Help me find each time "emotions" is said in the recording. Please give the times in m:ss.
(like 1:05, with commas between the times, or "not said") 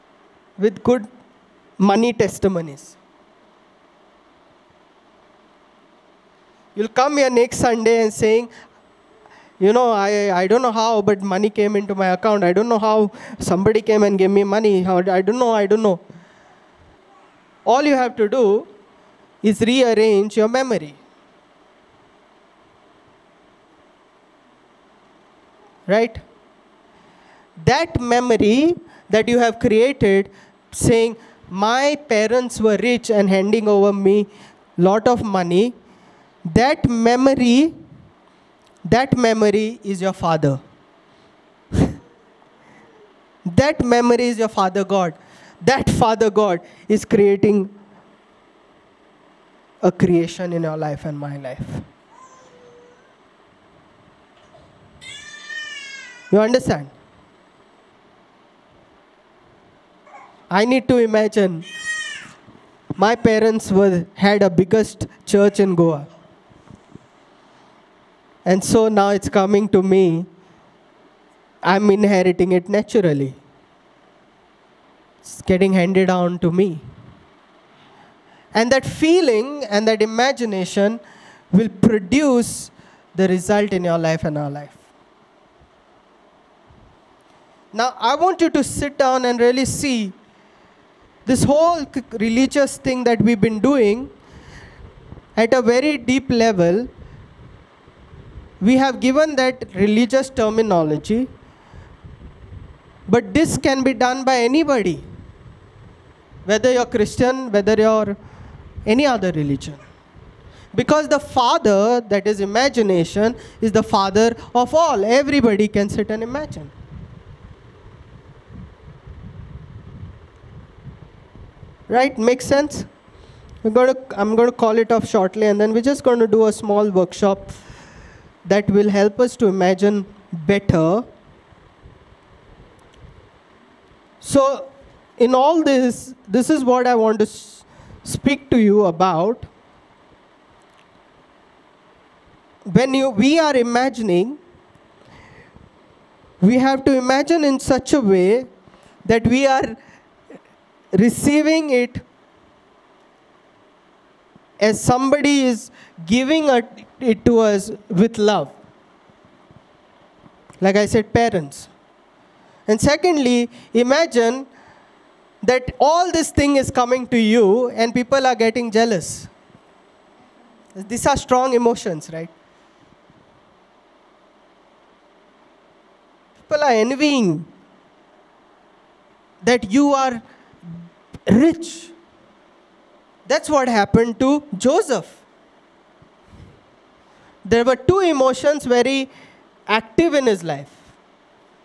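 2:51, 3:07.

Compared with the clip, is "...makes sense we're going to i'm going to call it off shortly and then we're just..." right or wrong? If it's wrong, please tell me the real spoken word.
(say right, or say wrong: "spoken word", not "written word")
right.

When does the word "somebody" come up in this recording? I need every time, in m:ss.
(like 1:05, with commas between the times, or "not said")
0:13, 2:34.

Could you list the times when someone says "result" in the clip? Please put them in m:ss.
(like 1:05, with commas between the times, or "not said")
1:23.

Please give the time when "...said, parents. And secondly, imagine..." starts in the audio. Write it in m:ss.
2:40.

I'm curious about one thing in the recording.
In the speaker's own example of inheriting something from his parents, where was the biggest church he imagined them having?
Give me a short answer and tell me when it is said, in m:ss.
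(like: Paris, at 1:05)
Goa, at 1:05.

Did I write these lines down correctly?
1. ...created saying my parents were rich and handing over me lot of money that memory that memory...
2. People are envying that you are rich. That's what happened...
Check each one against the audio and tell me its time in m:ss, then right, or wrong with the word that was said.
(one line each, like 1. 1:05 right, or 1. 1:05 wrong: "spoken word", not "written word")
1. 0:29 right
2. 2:56 right.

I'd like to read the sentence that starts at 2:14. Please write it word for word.
So, in all this, this is what I want to speak to you about.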